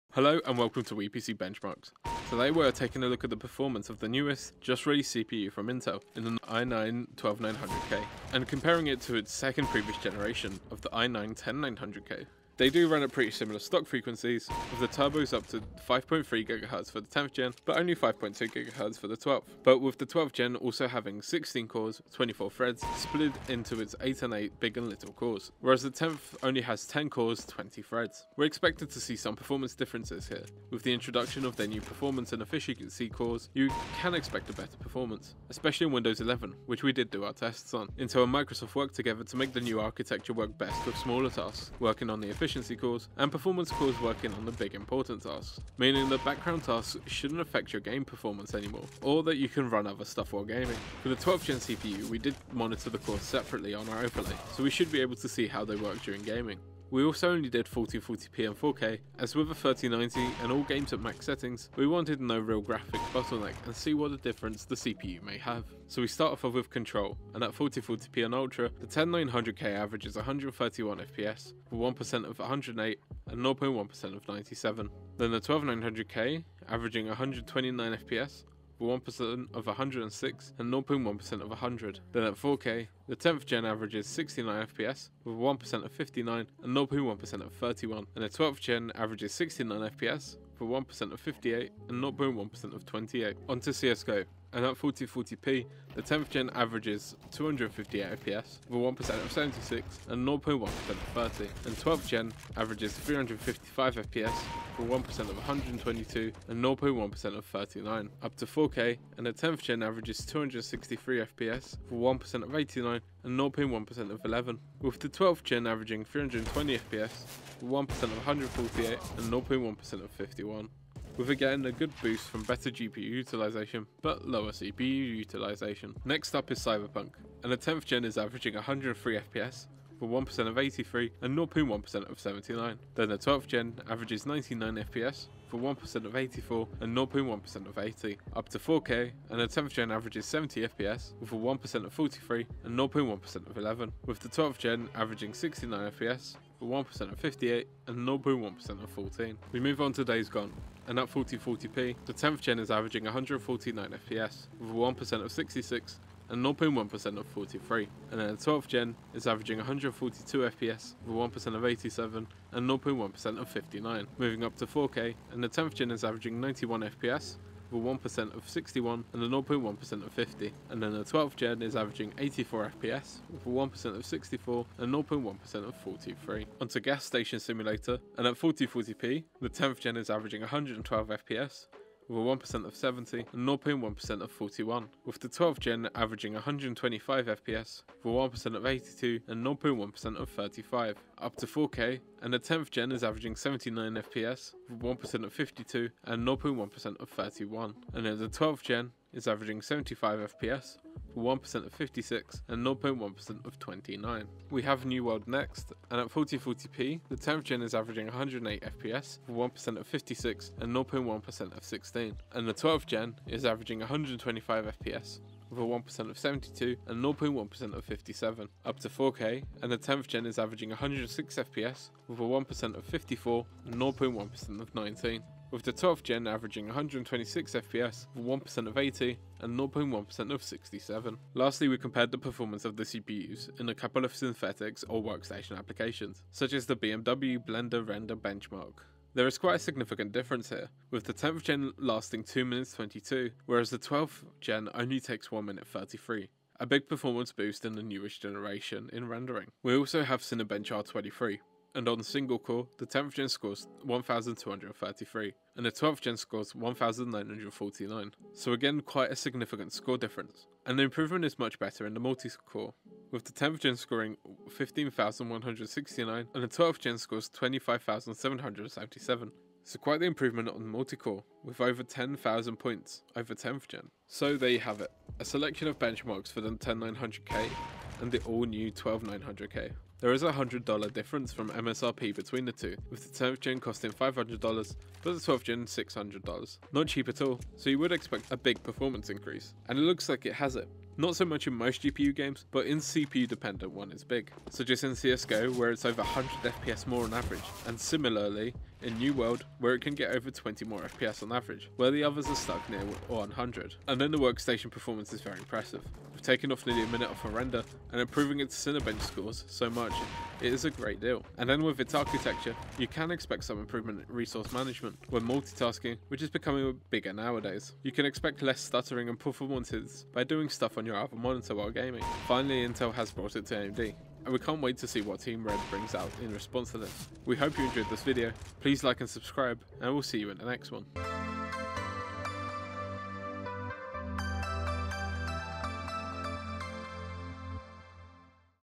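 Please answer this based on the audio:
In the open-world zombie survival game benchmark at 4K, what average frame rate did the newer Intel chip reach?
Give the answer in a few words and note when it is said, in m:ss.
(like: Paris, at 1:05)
84 FPS, at 2:52.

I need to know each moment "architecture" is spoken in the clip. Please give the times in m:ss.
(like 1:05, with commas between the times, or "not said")
0:39, 5:11.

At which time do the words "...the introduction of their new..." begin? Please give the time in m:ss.
0:30.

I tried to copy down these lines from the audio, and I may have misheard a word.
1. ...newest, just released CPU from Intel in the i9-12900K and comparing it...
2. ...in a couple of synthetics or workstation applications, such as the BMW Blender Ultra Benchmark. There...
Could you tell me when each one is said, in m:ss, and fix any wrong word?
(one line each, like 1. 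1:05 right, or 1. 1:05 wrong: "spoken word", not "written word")
1. 0:04 right
2. 3:53 wrong: "Render", not "Ultra".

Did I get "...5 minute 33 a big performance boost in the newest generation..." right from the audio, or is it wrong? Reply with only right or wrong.
wrong.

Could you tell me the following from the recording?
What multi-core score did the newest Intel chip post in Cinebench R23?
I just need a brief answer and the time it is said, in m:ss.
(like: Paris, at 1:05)
25,777, at 4:27.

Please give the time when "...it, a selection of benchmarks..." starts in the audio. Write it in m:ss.
4:34.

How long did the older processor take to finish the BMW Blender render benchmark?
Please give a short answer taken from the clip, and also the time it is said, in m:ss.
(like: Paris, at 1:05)
2 minutes 22, at 4:02.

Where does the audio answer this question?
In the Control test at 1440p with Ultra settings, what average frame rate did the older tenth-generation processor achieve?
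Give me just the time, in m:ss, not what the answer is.
1:10.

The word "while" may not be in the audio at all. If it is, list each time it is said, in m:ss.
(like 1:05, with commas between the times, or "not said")
0:50, 5:21.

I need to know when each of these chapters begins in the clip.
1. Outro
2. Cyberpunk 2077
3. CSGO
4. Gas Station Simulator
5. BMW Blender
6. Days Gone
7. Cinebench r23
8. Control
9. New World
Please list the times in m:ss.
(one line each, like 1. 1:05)
1. 4:34
2. 2:06
3. 1:34
4. 2:56
5. 3:51
6. 2:30
7. 4:09
8. 1:06
9. 3:24.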